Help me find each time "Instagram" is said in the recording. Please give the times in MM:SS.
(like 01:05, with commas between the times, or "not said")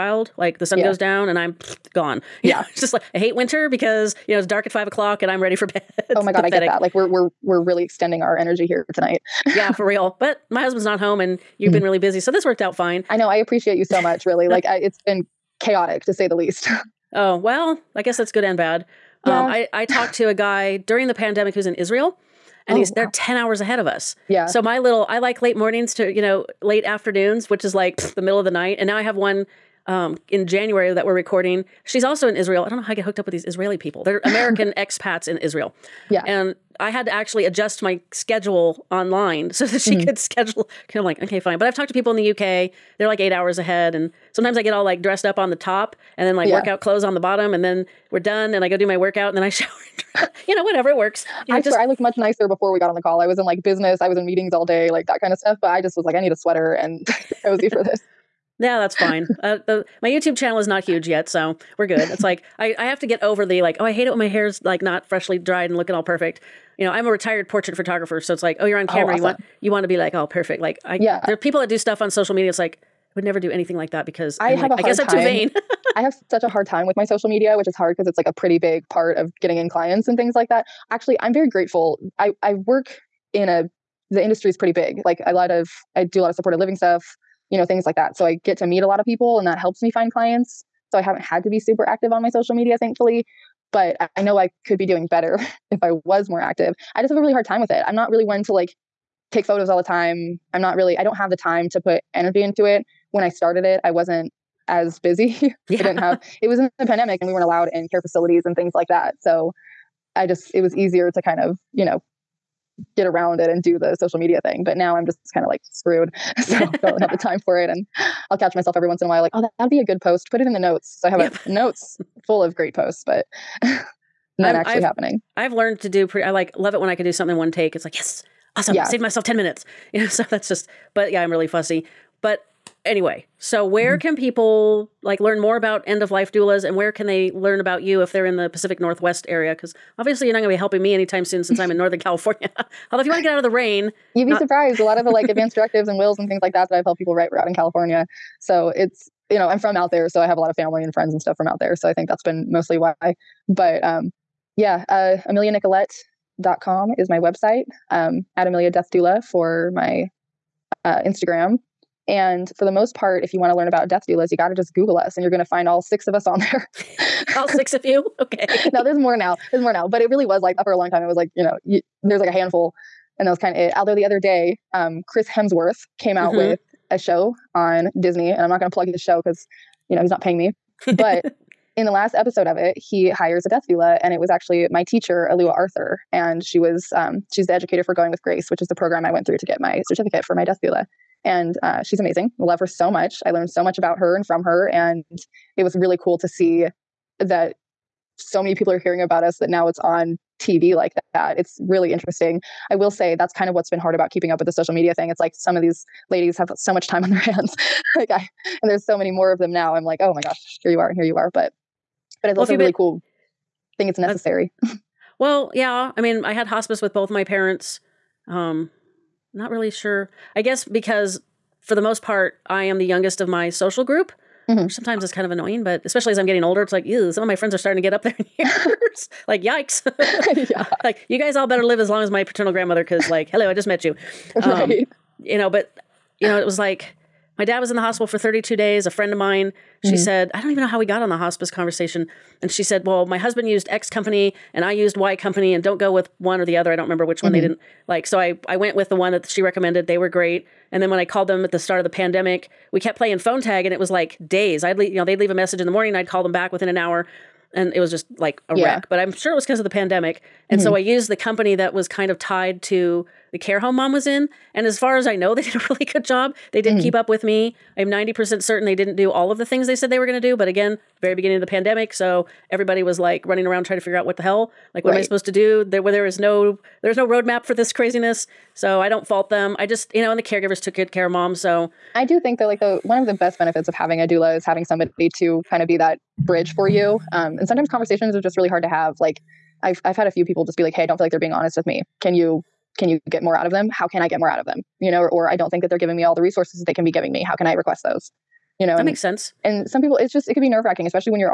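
02:41.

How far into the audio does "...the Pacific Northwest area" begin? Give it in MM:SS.
02:18.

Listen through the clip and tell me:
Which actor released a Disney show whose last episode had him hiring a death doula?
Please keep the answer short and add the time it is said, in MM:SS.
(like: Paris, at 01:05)
Chris Hemsworth, at 02:55.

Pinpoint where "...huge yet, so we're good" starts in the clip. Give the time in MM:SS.
01:00.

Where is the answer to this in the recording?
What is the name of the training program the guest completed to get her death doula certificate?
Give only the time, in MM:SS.
03:07.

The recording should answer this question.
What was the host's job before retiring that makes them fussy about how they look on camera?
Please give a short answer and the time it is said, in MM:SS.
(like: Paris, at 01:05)
Portrait photographer, at 01:07.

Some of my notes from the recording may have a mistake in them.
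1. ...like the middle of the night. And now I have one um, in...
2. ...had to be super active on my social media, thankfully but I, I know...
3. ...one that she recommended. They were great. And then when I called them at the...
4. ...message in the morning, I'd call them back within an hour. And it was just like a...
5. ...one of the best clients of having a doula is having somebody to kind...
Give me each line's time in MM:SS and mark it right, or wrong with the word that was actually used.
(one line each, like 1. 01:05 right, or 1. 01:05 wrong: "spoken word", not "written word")
1. 00:27 right
2. 01:31 right
3. 04:08 right
4. 04:15 right
5. 04:42 wrong: "benefits", not "clients".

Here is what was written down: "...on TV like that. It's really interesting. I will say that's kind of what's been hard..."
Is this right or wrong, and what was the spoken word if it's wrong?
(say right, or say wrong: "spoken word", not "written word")
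right.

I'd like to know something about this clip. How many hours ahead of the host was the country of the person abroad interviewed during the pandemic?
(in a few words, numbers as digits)
10.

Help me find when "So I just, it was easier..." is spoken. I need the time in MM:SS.
01:49.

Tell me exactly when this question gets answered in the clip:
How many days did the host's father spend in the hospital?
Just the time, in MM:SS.
03:58.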